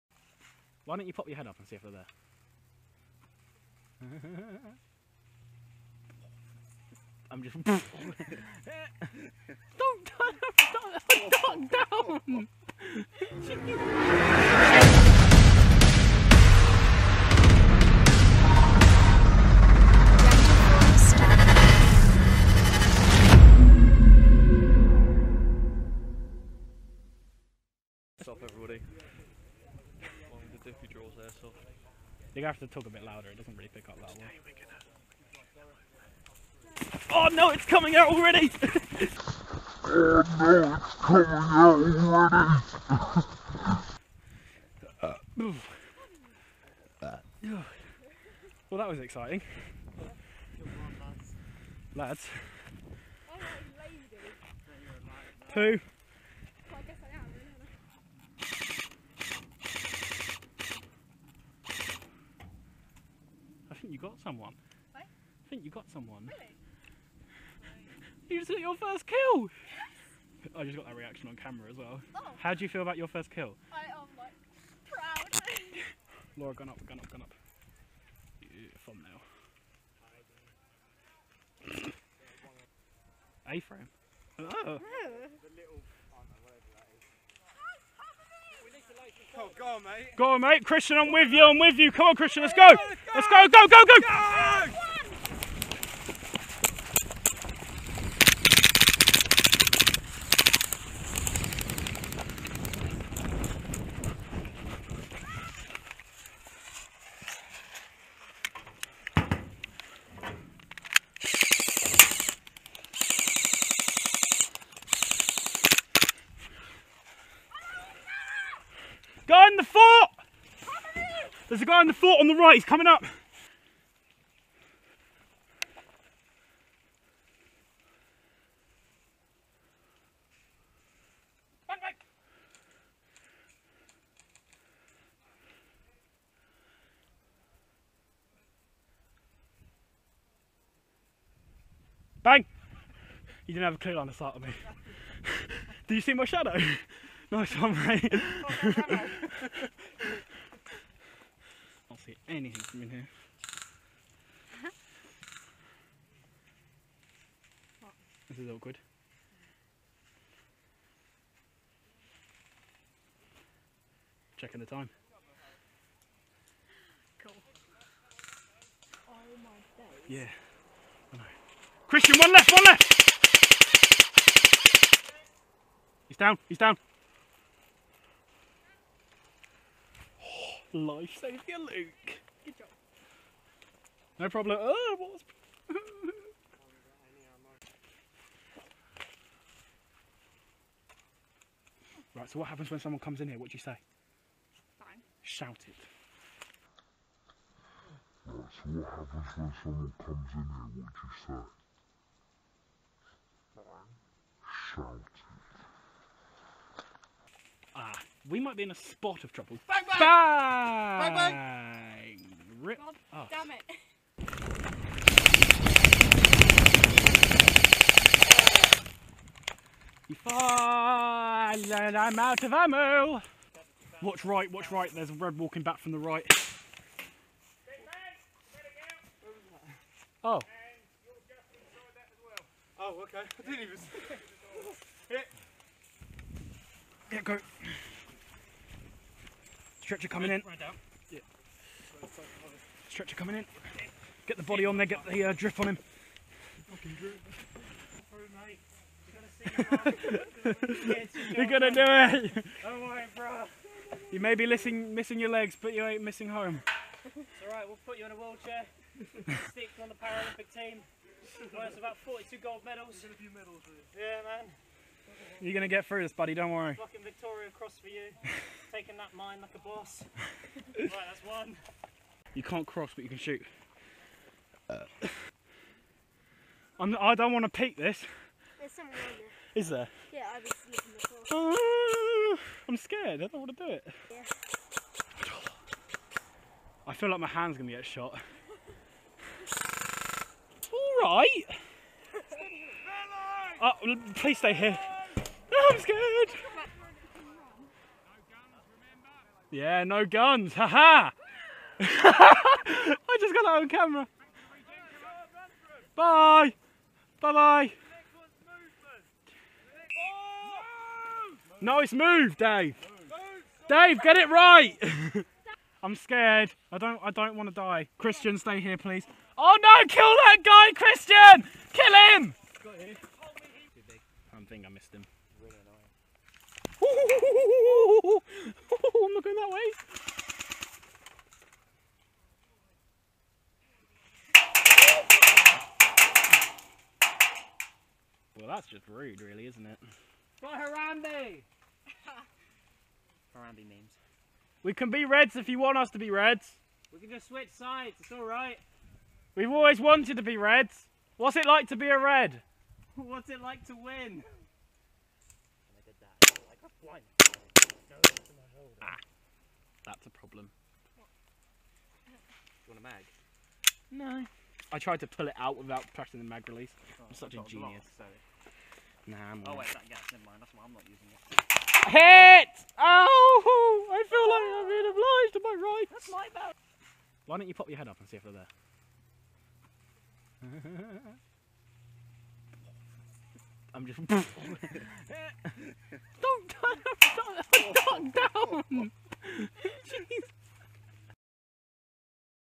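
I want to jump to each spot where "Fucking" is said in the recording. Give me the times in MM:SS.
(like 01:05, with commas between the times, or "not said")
04:26.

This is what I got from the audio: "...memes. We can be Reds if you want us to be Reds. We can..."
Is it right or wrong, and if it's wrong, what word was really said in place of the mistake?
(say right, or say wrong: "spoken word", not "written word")
right.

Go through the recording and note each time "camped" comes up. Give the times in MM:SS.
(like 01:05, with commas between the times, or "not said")
not said.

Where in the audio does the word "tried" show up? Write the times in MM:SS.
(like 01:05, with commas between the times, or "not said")
06:04.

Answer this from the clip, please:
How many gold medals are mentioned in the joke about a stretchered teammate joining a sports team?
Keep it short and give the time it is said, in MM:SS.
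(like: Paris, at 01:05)
42, at 04:22.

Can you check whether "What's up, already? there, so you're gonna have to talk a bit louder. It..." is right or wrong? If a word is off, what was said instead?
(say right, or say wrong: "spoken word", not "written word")
wrong: "everybody", not "already".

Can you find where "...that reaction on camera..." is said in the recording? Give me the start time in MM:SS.
01:10.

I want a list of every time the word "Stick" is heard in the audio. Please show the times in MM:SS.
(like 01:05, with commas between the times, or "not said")
04:19.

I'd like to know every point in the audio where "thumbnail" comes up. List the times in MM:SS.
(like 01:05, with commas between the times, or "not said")
01:18.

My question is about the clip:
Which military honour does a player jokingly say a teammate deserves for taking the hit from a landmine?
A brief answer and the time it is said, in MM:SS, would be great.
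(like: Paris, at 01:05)
Victoria Cross, at 04:27.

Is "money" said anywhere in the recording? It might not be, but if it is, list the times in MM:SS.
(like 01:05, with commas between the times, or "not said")
not said.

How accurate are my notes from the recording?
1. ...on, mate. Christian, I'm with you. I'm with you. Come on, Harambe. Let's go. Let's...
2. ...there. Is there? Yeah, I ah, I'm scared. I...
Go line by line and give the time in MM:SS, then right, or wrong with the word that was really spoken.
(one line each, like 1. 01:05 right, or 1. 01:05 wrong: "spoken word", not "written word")
1. 01:30 wrong: "Christian", not "Harambe"
2. 04:38 right.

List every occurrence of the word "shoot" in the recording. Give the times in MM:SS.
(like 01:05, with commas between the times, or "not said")
04:33.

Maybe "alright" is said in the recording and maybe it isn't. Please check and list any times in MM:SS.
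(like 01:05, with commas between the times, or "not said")
04:17, 05:48.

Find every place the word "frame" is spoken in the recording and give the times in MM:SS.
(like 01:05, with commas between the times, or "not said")
01:23.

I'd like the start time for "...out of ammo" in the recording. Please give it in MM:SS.
03:42.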